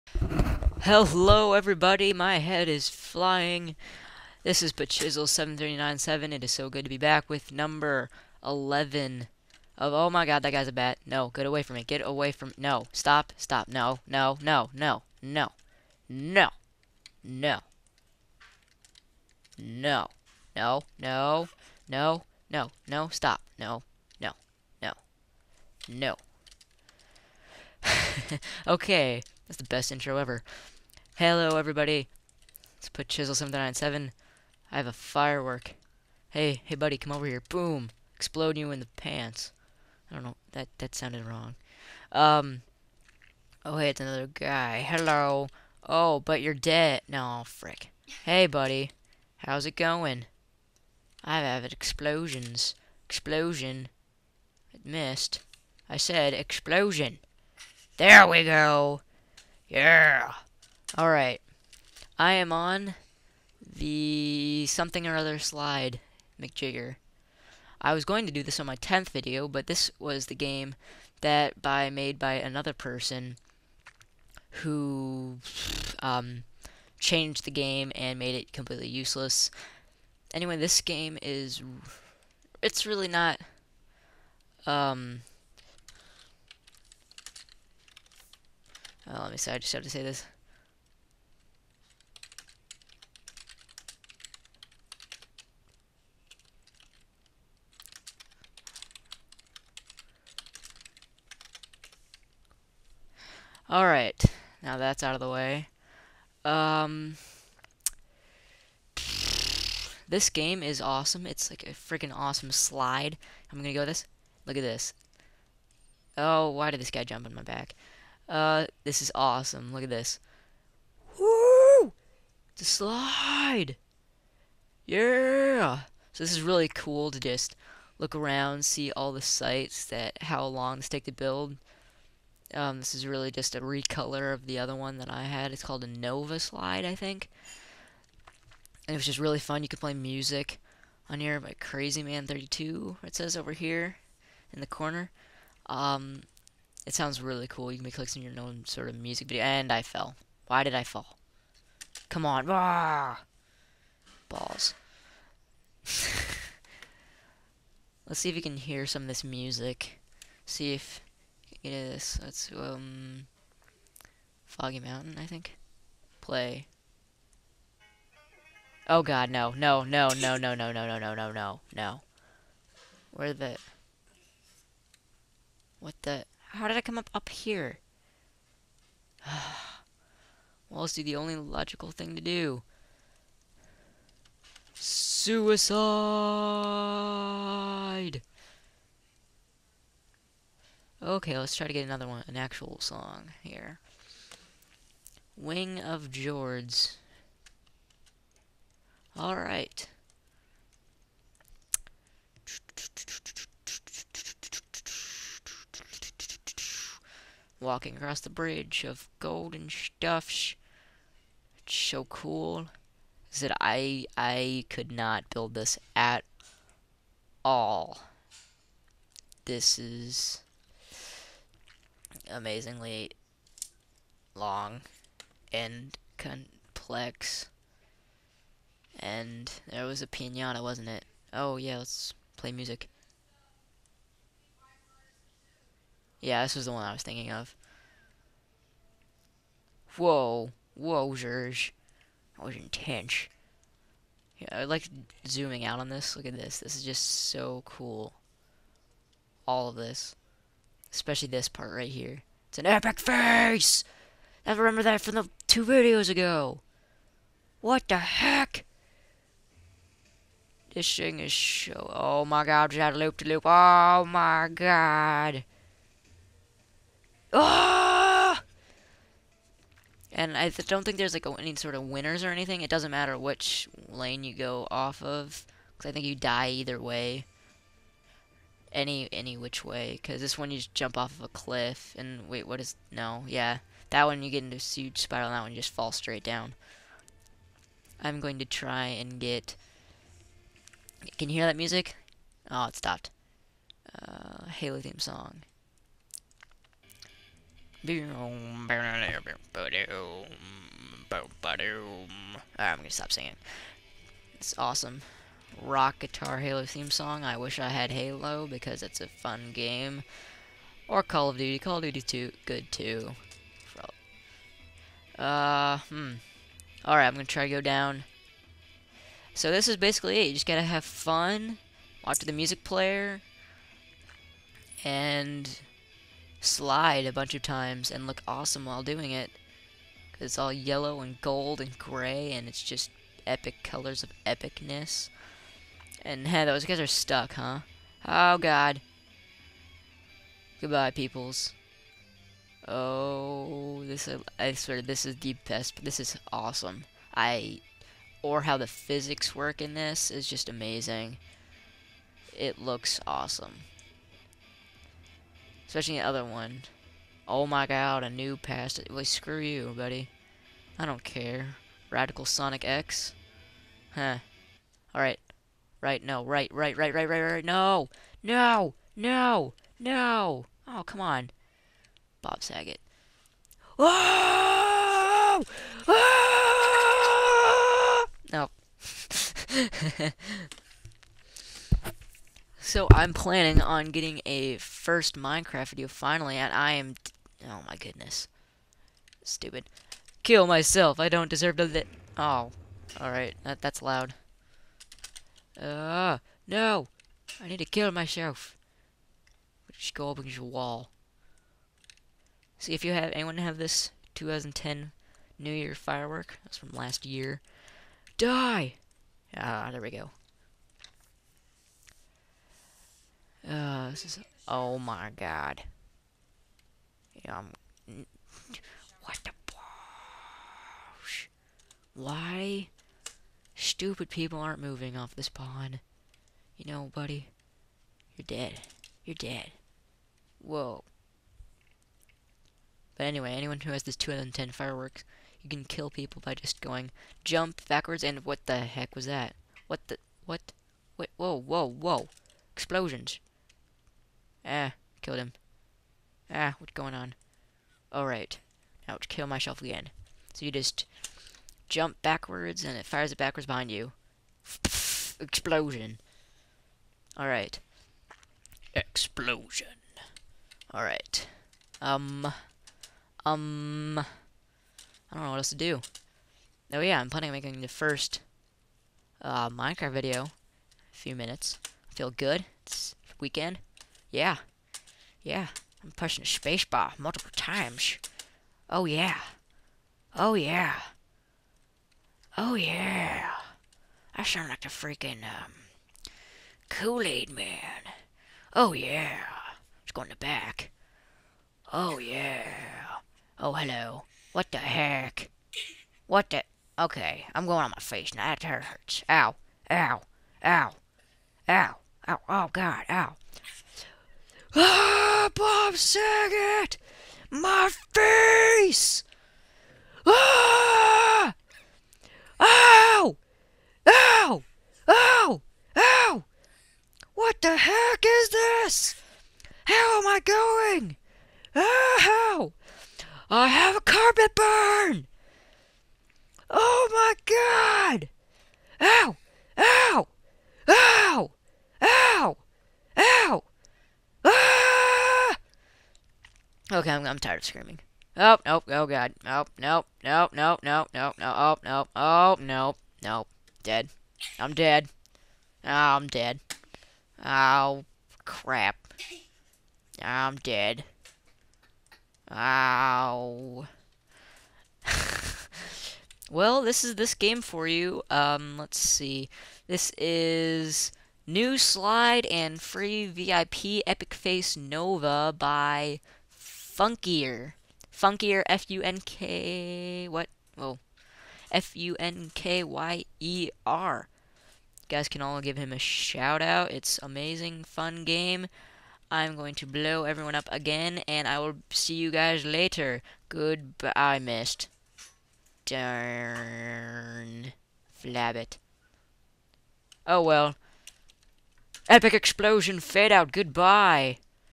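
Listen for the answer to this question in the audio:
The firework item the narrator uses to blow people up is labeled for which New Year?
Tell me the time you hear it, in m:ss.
6:44.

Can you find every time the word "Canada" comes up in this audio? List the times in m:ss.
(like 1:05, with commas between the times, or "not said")
not said.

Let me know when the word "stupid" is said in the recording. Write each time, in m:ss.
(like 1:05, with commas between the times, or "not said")
6:29, 7:03.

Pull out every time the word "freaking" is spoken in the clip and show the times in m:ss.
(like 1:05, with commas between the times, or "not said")
1:51, 8:04.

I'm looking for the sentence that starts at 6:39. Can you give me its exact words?
Just go up against a wall.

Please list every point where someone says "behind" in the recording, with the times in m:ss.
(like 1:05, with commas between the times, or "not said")
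7:33.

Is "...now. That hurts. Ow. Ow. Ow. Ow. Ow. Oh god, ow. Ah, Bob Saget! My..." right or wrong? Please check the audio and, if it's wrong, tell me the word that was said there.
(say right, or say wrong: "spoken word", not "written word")
right.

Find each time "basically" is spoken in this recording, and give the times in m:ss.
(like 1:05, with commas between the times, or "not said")
5:19.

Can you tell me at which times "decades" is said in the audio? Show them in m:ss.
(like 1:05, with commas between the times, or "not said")
not said.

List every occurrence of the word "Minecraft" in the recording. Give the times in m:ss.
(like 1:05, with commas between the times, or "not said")
6:25, 7:49.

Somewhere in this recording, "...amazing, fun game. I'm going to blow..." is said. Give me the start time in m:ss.
9:37.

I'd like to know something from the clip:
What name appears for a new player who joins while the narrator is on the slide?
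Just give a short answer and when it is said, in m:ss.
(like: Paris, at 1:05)
Radical Sonic X, at 6:01.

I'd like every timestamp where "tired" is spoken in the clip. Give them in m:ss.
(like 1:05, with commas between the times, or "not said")
8:57.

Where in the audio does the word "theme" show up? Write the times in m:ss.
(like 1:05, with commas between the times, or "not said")
4:54, 5:06.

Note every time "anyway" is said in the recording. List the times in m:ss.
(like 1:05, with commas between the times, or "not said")
1:20, 7:13.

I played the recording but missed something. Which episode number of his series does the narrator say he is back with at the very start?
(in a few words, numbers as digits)
11.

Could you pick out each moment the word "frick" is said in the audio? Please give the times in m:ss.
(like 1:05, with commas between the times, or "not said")
0:47.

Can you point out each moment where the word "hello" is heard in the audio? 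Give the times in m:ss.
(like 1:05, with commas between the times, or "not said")
0:00, 0:31, 0:44, 8:13.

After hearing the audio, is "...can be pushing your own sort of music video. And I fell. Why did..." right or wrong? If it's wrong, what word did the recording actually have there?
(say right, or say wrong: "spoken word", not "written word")
wrong: "clicking", not "pushing".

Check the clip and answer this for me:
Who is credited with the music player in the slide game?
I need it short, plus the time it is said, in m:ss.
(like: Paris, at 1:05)
Crazy Man 32, at 2:21.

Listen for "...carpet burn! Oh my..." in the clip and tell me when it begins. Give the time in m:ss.
8:43.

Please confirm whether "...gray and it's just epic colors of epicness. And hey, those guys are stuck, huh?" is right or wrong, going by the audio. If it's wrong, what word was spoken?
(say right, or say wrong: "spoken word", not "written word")
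right.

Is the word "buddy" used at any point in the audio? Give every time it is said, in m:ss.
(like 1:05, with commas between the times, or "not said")
0:36, 0:48, 5:59, 7:06.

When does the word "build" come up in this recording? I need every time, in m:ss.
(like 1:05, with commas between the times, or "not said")
2:11, 3:35.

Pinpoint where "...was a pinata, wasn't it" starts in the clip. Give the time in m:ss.
3:49.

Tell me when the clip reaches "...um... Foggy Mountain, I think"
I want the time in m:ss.
2:42.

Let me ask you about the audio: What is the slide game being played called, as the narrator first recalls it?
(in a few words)
Nova Slide.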